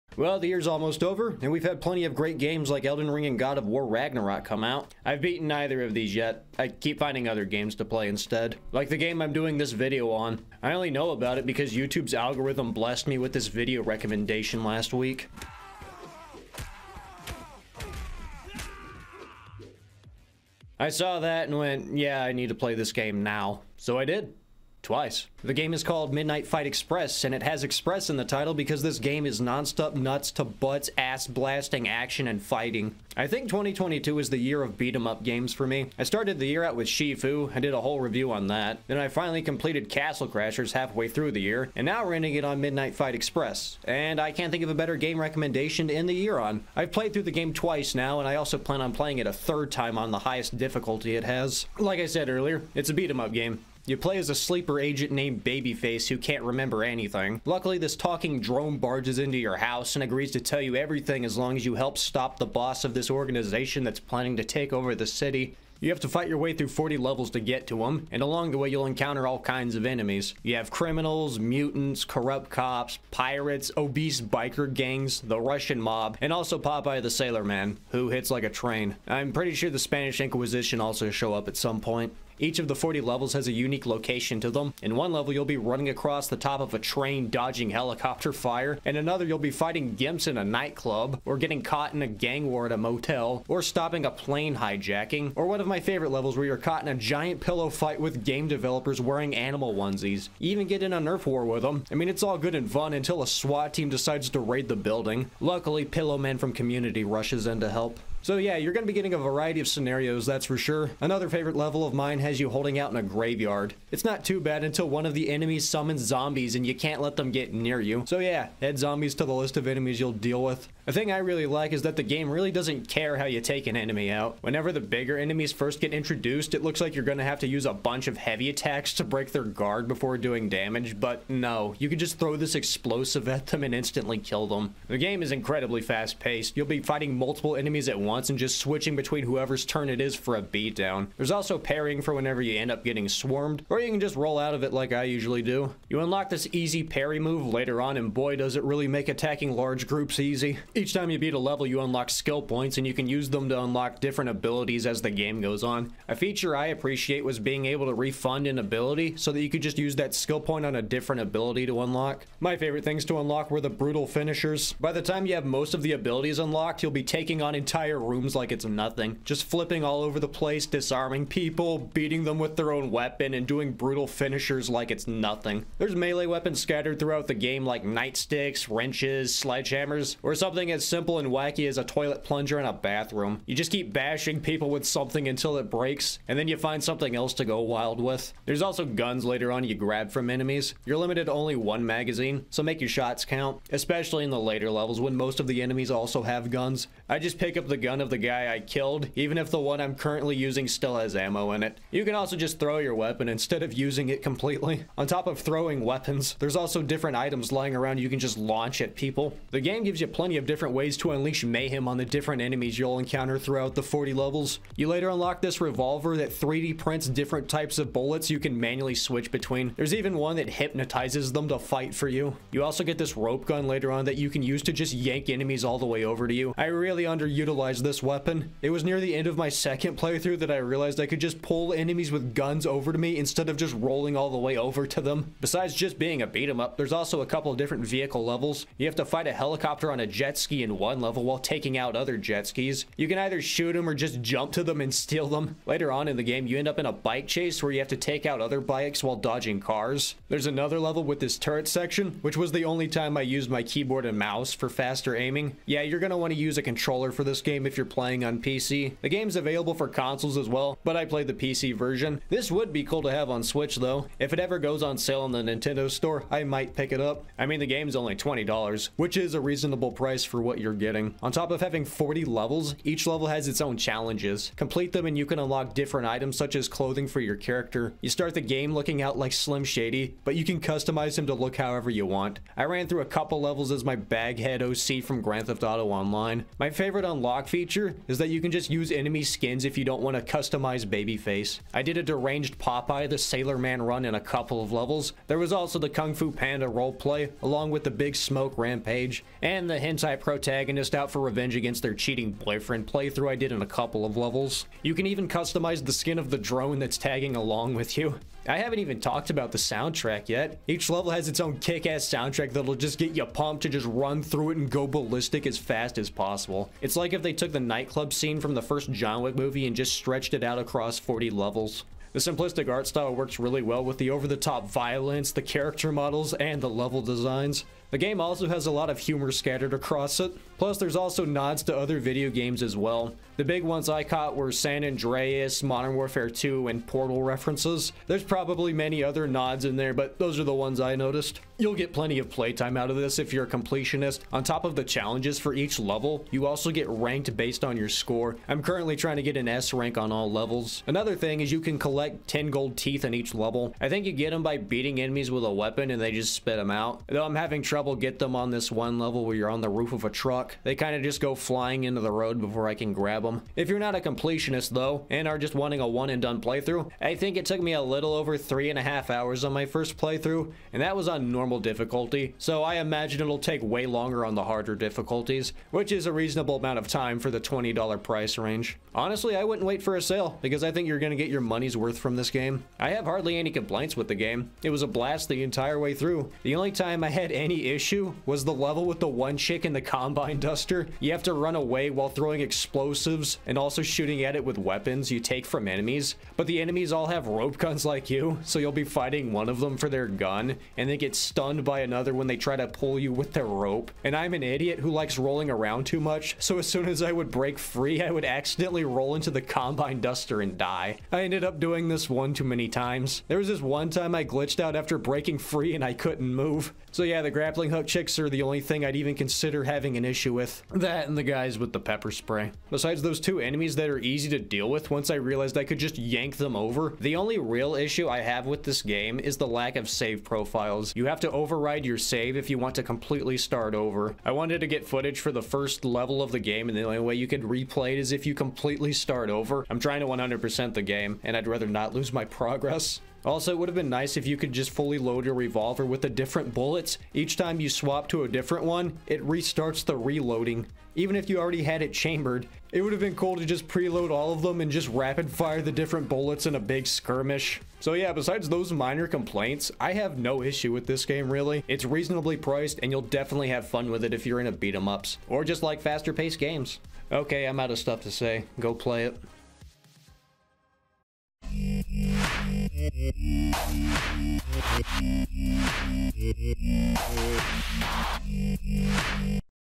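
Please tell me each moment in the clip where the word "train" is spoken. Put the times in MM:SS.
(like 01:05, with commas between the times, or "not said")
01:18, 01:26.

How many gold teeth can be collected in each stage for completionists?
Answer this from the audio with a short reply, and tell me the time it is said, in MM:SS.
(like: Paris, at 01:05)
10, at 05:52.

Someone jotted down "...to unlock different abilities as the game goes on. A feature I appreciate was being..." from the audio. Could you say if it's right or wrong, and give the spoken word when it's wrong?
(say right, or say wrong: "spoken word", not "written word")
right.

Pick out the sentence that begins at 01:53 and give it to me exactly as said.
It's not too bad until one of the enemies summons zombies and you can't let them get near you.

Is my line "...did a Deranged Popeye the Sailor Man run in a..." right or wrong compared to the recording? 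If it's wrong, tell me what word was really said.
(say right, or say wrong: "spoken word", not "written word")
right.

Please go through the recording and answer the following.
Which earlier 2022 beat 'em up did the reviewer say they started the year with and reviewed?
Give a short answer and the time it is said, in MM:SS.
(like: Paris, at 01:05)
Sifu, at 00:36.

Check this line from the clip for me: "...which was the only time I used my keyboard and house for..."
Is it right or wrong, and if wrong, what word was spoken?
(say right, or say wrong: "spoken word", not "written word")
wrong: "mouse", not "house".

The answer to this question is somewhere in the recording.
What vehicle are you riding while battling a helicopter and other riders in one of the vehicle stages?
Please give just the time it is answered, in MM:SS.
04:00.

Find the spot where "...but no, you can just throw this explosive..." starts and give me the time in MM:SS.
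02:10.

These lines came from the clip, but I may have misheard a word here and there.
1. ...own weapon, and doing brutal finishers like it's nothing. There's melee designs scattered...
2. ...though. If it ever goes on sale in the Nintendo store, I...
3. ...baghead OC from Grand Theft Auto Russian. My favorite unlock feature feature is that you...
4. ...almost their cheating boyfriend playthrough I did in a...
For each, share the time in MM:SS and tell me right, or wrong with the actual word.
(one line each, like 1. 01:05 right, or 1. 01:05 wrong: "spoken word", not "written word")
1. 02:52 wrong: "weapons", not "designs"
2. 04:23 right
3. 04:43 wrong: "Online", not "Russian"
4. 05:01 wrong: "against", not "almost".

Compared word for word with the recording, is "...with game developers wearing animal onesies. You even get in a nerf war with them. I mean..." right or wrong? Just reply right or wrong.
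right.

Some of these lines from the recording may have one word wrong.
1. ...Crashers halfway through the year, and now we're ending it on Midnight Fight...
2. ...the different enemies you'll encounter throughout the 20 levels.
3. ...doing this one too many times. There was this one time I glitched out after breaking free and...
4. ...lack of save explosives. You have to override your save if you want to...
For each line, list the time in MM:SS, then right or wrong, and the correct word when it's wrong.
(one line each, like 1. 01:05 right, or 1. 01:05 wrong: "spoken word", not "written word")
1. 00:40 right
2. 03:31 wrong: "40", not "20"
3. 06:51 right
4. 07:09 wrong: "profiles", not "explosives".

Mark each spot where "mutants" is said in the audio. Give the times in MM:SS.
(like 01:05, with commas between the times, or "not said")
01:11.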